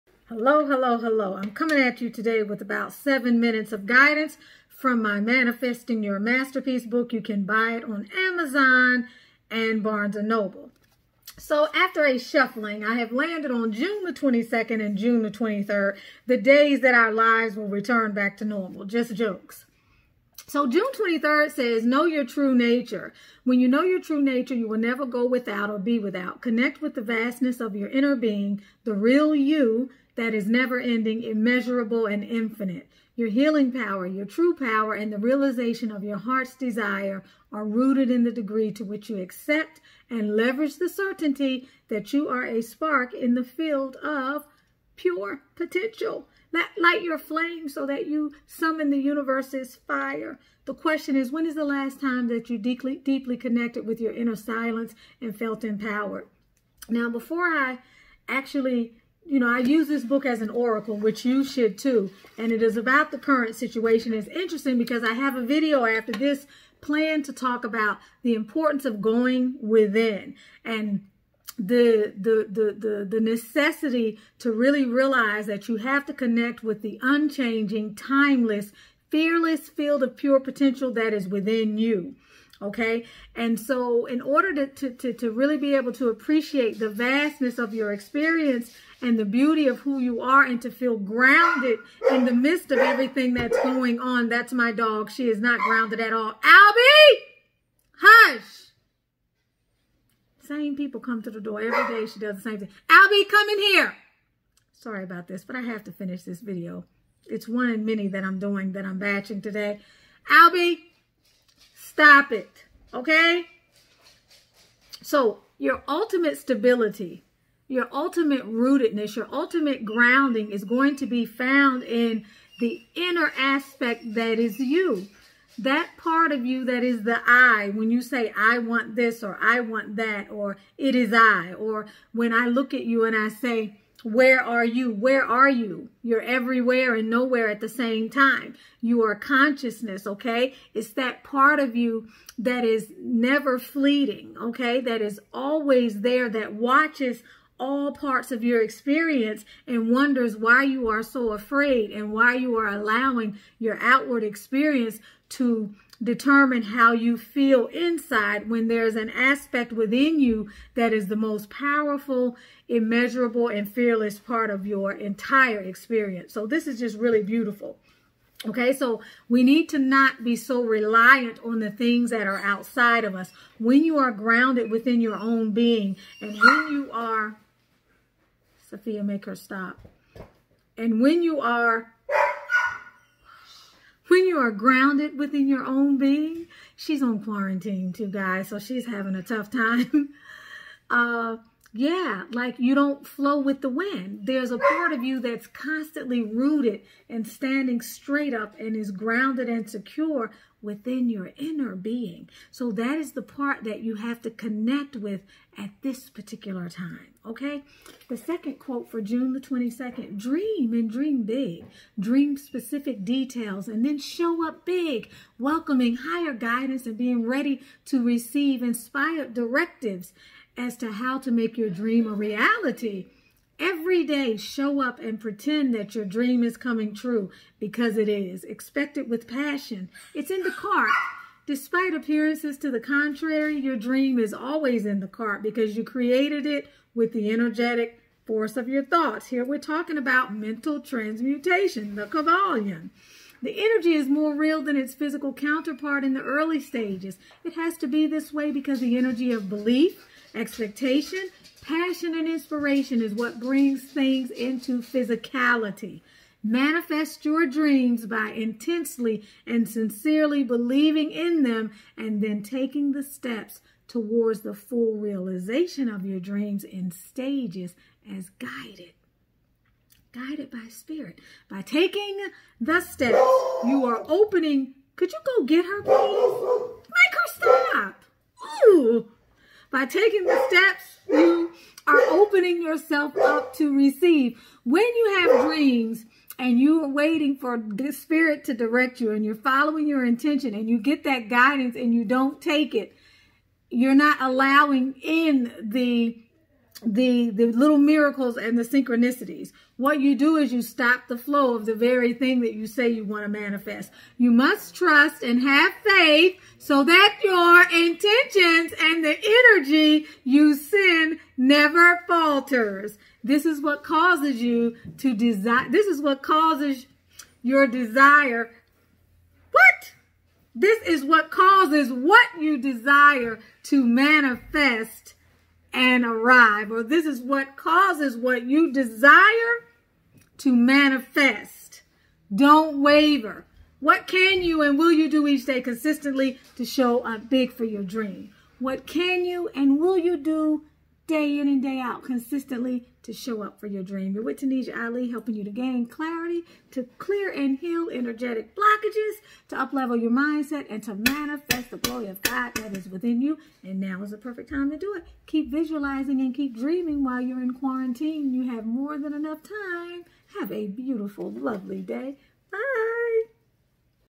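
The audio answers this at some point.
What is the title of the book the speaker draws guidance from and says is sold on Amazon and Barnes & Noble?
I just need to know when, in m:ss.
0:05.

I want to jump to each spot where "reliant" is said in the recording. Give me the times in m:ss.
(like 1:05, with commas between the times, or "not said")
2:50.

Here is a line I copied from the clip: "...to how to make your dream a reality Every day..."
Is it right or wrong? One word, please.
right.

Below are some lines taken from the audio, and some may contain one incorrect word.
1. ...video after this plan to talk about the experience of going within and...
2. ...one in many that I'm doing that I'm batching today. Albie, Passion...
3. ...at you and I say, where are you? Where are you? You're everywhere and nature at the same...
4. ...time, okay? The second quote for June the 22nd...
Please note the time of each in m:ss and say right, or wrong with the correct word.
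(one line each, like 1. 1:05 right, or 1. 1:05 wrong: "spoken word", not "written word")
1. 1:05 wrong: "importance", not "experience"
2. 1:47 wrong: "Stop", not "Passion"
3. 2:12 wrong: "nowhere", not "nature"
4. 3:26 right.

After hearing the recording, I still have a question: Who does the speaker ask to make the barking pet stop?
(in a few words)
Sophia.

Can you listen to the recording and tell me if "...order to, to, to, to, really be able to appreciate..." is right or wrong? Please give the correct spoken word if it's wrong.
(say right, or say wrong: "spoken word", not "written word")
right.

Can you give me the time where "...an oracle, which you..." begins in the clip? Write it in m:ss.
1:00.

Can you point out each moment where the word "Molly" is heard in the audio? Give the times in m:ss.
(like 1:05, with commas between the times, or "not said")
not said.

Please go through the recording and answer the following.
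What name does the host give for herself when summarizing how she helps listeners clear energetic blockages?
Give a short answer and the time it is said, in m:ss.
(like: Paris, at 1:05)
Tunisia Ali, at 5:44.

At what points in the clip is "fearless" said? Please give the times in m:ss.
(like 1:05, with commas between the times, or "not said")
1:19, 2:43.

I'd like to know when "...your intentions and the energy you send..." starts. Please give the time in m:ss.
5:07.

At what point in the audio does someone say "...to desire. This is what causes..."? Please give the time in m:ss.
5:14.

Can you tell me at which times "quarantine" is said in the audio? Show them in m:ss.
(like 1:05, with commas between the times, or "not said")
3:07, 5:57.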